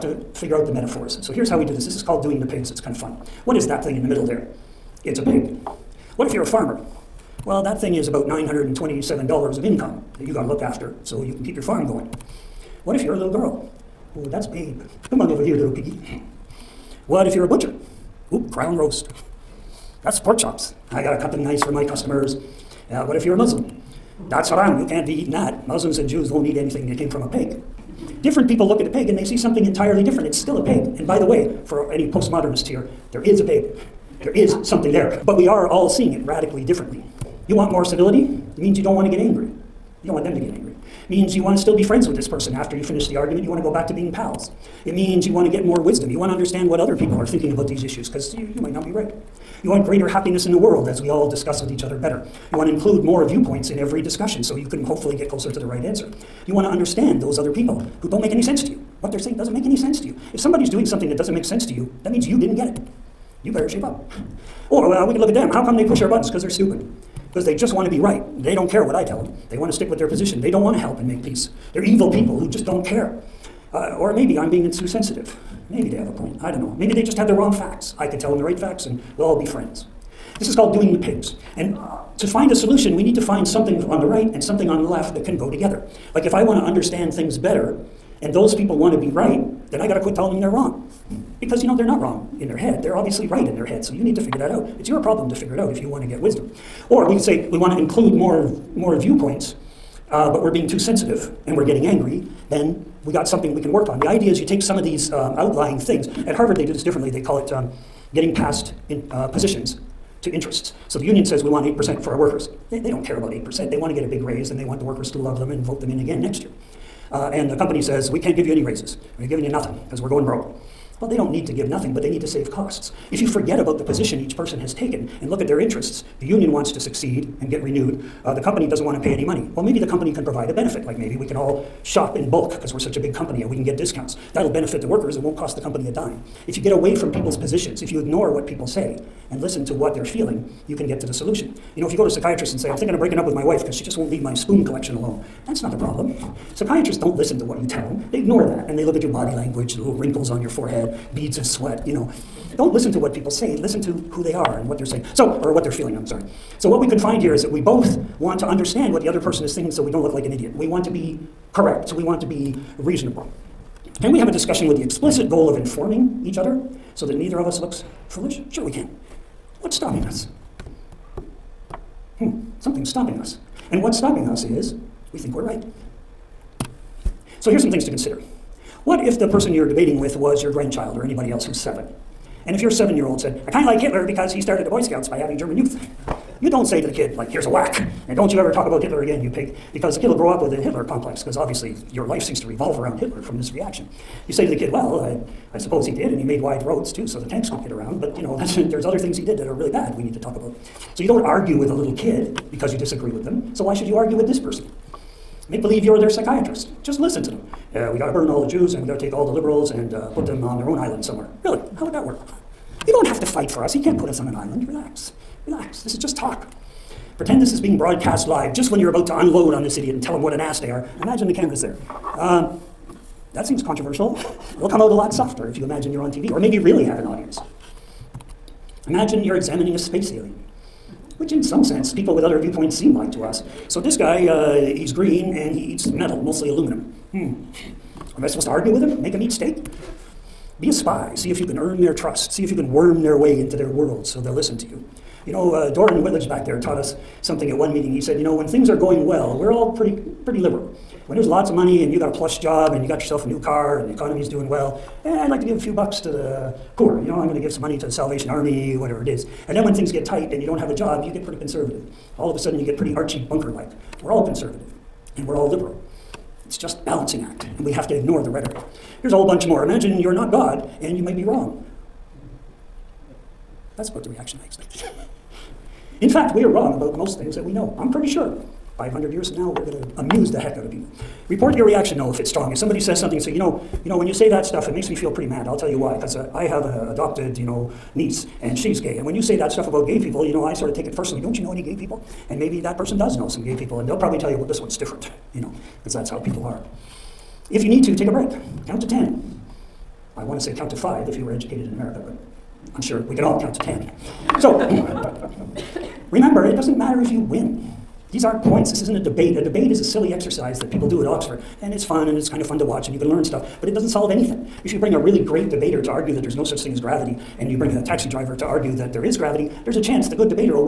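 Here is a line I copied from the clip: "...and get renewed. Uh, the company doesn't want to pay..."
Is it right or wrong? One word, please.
right.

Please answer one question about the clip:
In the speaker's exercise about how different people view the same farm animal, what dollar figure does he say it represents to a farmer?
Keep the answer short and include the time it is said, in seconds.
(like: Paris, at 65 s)
$927, at 8 s.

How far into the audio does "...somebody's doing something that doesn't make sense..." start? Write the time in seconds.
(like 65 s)
60 s.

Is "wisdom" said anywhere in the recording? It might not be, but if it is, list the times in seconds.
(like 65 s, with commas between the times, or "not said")
45 s, 96 s.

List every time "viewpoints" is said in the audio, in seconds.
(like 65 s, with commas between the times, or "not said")
53 s, 98 s, 232 s.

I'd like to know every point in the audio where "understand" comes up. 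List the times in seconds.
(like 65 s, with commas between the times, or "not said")
46 s, 56 s, 86 s, 158 s.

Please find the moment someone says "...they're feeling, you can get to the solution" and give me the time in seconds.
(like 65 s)
139 s.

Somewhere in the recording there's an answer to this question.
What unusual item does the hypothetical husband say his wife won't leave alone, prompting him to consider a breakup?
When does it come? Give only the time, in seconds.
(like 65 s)
144 s.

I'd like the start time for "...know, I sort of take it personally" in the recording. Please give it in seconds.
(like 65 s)
290 s.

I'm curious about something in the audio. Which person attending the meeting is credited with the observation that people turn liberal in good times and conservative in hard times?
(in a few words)
Doran Whitledge.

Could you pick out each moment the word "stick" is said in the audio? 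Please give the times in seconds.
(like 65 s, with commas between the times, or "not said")
69 s.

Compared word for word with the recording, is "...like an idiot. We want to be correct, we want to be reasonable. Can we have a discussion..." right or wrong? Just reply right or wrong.
right.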